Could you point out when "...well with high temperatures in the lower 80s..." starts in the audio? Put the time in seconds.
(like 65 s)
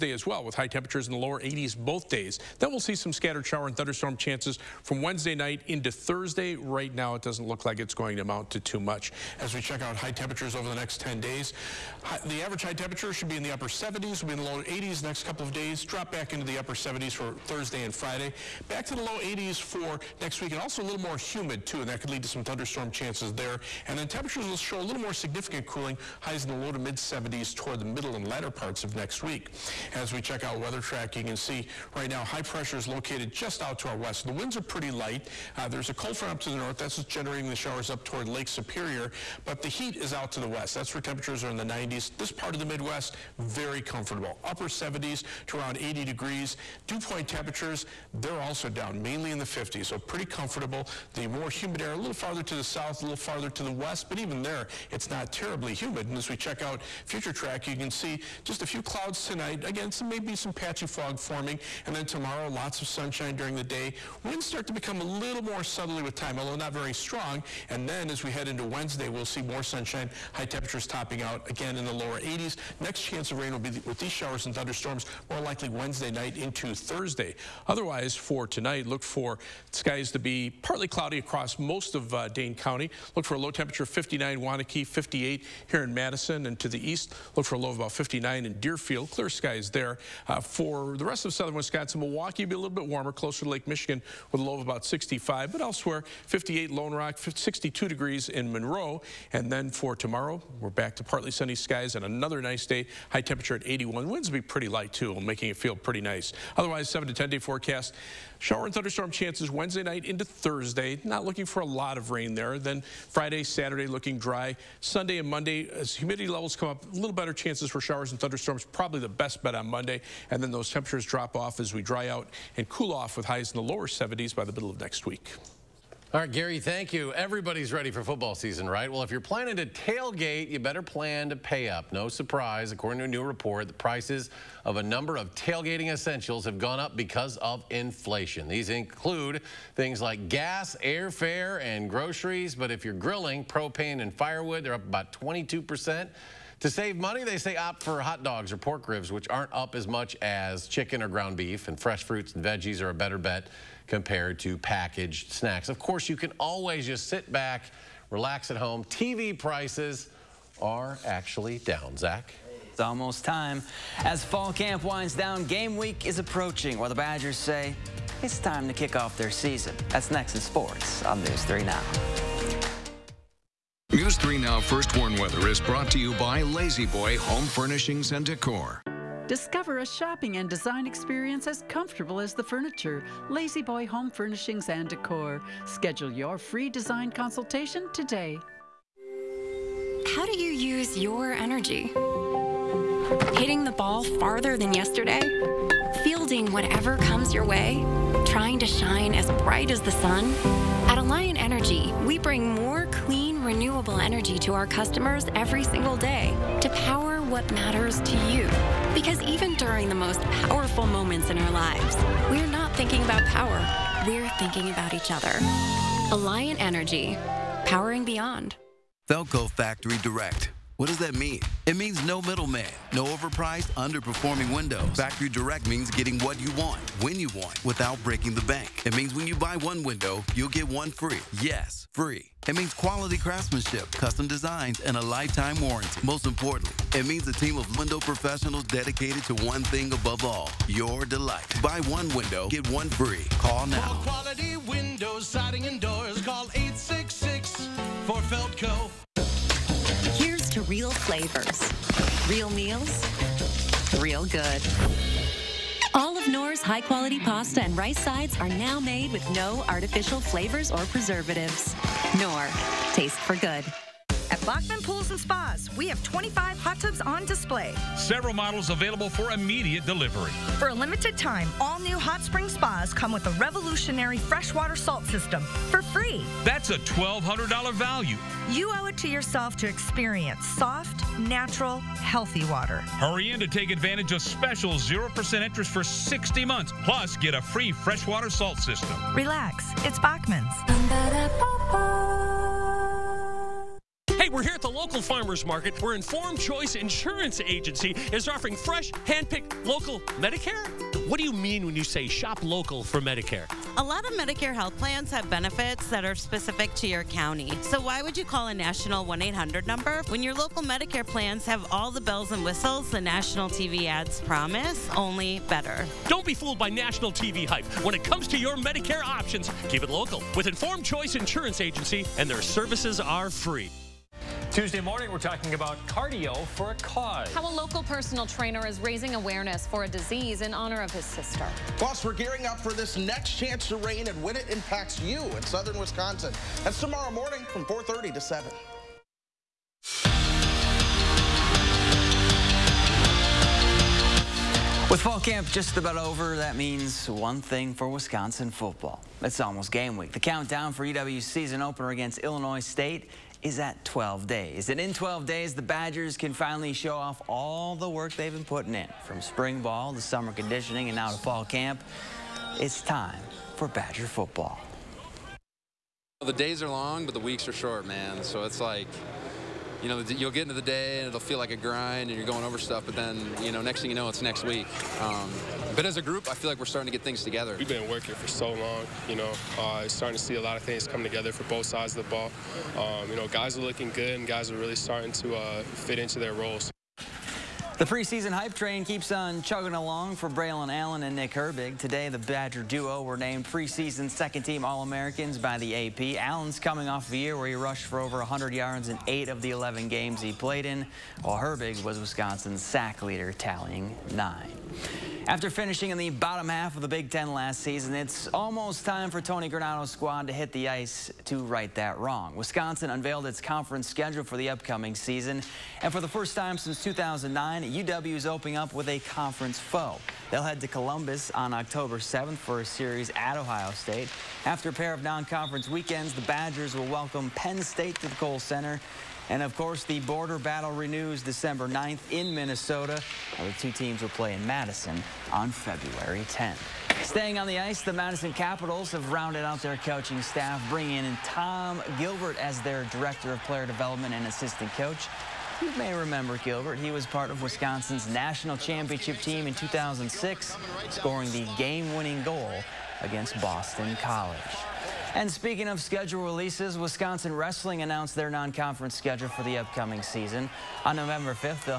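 0 s.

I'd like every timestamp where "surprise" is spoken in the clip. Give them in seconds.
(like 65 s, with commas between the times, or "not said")
132 s.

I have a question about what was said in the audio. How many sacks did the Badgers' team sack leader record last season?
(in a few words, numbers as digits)
9.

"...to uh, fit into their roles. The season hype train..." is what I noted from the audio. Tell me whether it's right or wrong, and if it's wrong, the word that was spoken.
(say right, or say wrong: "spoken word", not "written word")
wrong: "preseason", not "season".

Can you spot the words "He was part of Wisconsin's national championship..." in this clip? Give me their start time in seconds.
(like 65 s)
446 s.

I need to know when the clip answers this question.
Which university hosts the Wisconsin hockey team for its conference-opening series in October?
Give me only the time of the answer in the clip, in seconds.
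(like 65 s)
423 s.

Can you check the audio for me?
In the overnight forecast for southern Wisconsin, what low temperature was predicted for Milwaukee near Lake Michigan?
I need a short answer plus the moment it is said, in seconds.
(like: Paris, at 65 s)
65, at 94 s.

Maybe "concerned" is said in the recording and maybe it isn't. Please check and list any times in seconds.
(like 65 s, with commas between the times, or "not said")
not said.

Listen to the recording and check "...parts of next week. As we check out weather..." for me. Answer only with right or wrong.
right.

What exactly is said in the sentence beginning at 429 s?
And, of course, the border battle renews December 9th in Minnesota.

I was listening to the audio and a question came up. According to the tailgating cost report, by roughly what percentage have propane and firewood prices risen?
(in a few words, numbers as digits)
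22 percent.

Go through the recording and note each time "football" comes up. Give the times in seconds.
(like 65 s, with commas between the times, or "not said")
128 s, 348 s, 364 s.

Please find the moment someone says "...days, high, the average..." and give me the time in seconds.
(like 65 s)
11 s.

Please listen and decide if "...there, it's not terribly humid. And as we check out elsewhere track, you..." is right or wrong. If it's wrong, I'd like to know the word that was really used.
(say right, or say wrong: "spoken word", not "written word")
wrong: "future", not "elsewhere".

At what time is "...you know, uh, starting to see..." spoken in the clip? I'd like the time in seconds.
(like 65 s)
379 s.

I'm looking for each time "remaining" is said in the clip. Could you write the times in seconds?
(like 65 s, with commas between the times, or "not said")
not said.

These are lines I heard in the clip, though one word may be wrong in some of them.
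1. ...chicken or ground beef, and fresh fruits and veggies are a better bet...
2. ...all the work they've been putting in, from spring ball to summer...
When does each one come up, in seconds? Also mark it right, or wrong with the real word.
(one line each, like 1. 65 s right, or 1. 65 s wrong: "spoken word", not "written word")
1. 150 s right
2. 357 s right.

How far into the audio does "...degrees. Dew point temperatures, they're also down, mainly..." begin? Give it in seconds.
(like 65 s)
46 s.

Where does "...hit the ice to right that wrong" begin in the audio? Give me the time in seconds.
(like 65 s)
410 s.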